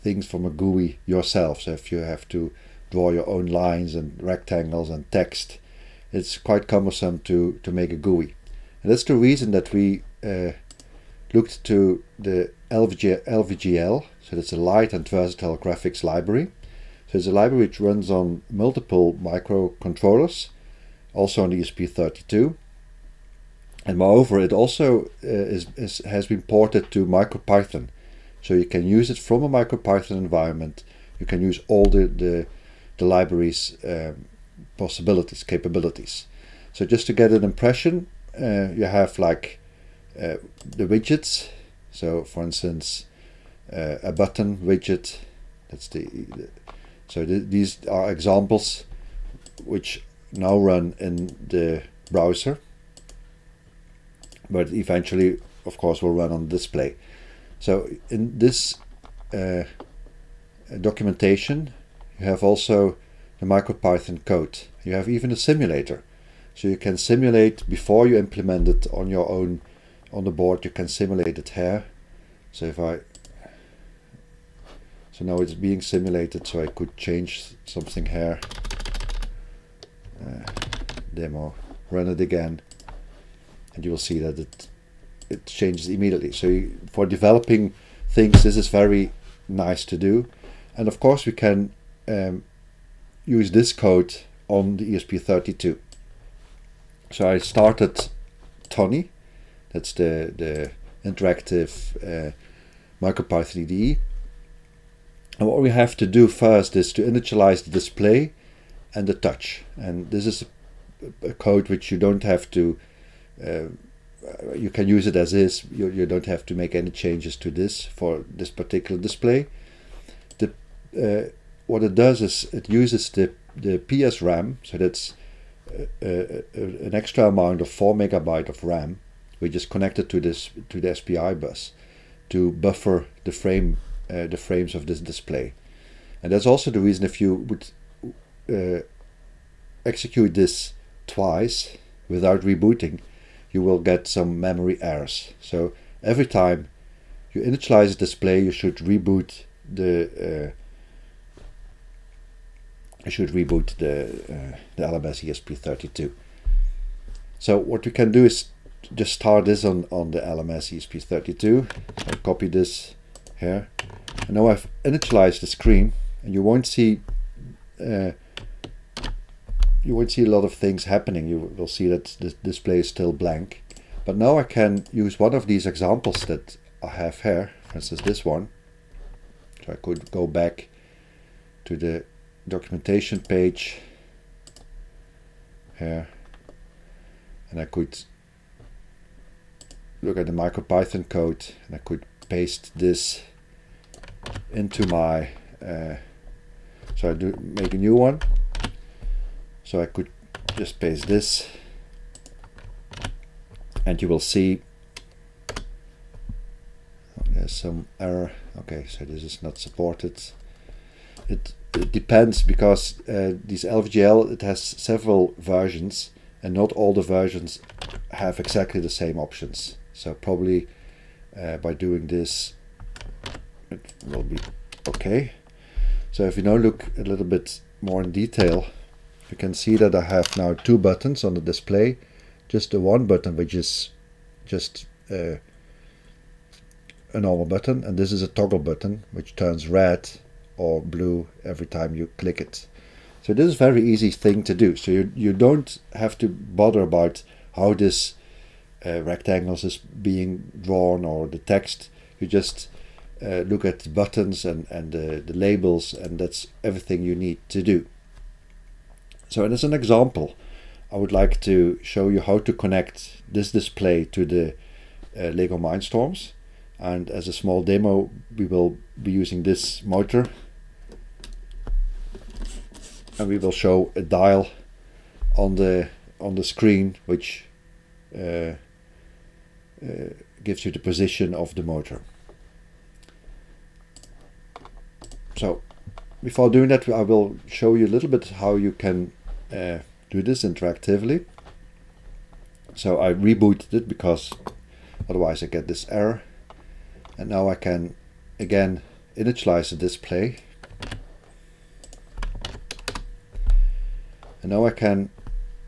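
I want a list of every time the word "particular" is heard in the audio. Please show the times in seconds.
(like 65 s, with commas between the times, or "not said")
118 s.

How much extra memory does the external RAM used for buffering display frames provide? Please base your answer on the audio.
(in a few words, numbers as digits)
4 megabytes.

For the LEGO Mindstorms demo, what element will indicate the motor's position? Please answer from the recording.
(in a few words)
a dial.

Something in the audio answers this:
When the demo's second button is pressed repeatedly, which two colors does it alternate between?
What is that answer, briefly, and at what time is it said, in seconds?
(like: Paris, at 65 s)
red or blue, at 239 s.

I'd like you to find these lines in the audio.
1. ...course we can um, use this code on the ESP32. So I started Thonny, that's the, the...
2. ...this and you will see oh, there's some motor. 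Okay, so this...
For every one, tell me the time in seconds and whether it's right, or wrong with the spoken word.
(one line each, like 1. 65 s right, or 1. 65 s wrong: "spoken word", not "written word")
1. 90 s right
2. 201 s wrong: "error", not "motor".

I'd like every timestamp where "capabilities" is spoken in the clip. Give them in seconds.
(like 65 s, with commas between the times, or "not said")
35 s.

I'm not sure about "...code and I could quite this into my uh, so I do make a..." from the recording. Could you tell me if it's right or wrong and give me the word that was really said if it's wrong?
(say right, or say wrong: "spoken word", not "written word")
wrong: "paste", not "quite".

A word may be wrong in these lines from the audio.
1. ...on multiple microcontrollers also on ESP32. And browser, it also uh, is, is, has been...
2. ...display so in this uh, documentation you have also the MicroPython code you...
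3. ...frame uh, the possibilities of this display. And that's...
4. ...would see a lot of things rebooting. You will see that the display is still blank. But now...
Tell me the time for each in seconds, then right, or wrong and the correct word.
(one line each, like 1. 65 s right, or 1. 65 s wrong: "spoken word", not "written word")
1. 18 s wrong: "moreover", not "browser"
2. 56 s right
3. 133 s wrong: "frames", not "possibilities"
4. 169 s wrong: "happening", not "rebooting".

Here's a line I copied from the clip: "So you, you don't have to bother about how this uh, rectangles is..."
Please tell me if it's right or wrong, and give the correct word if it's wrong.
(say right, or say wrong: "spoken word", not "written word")
right.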